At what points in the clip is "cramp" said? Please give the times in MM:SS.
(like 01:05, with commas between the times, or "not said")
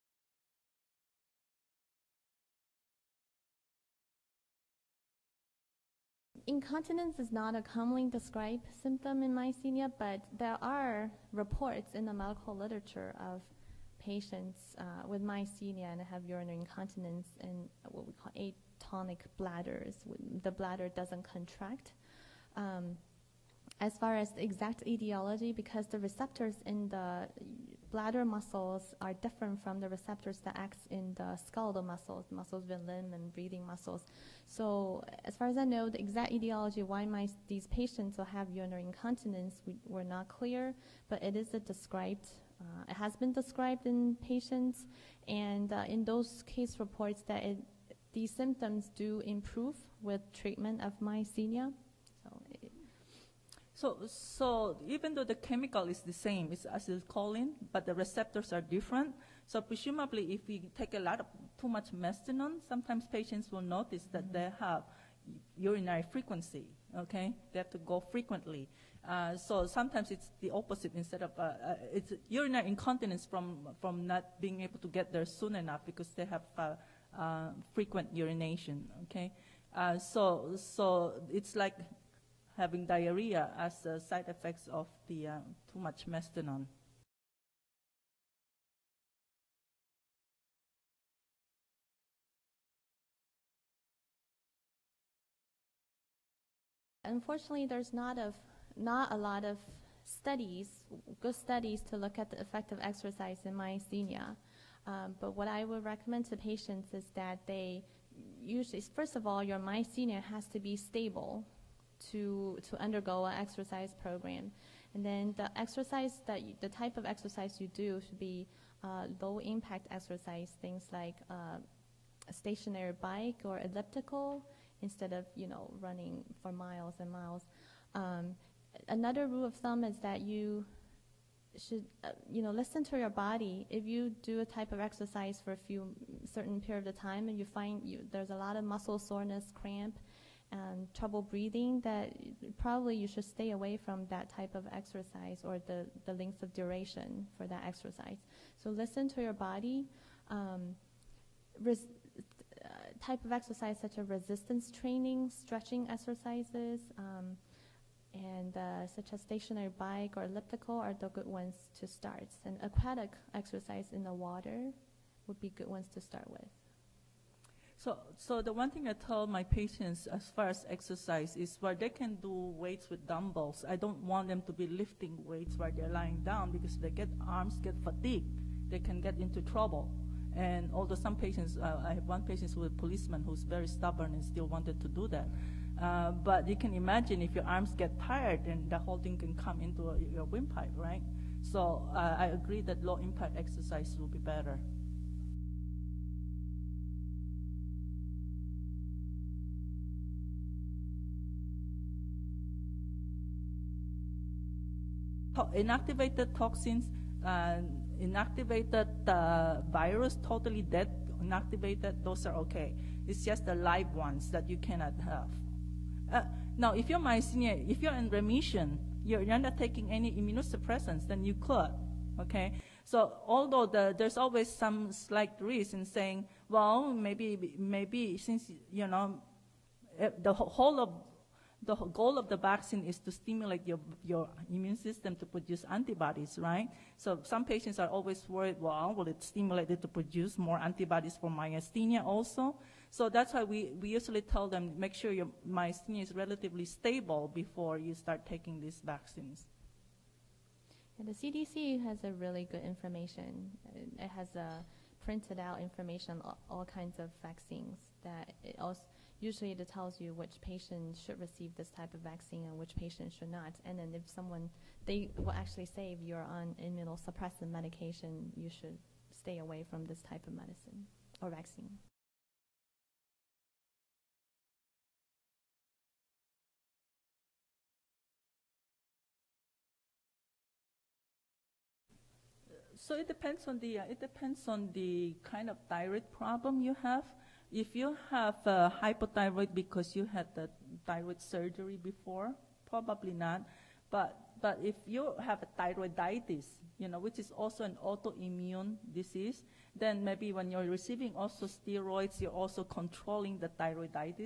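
02:19.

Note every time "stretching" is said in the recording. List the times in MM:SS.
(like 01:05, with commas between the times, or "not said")
02:35.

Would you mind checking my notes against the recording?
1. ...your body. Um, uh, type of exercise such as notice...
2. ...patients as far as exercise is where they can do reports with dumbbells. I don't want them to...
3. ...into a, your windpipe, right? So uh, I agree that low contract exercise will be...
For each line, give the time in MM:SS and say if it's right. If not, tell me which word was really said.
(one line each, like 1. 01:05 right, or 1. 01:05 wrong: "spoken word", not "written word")
1. 02:29 wrong: "resistance", not "notice"
2. 02:49 wrong: "weights", not "reports"
3. 03:09 wrong: "impact", not "contract".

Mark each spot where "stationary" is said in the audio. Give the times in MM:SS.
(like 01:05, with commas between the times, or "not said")
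02:02, 02:39.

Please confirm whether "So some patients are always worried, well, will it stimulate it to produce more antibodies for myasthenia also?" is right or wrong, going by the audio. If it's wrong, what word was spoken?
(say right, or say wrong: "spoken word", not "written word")
right.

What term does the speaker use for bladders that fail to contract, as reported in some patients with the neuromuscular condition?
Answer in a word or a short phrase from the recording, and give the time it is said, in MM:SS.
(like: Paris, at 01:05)
atonic bladders, at 00:18.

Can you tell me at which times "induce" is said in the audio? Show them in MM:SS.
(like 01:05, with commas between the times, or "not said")
not said.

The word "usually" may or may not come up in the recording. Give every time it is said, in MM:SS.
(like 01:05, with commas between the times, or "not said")
01:48, 04:03, 04:19.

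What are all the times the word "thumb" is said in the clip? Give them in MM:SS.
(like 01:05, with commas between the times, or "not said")
02:09.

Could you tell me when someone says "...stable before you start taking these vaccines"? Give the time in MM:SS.
04:06.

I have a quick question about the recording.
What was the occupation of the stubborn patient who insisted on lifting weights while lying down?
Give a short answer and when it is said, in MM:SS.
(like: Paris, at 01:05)
policeman, at 03:02.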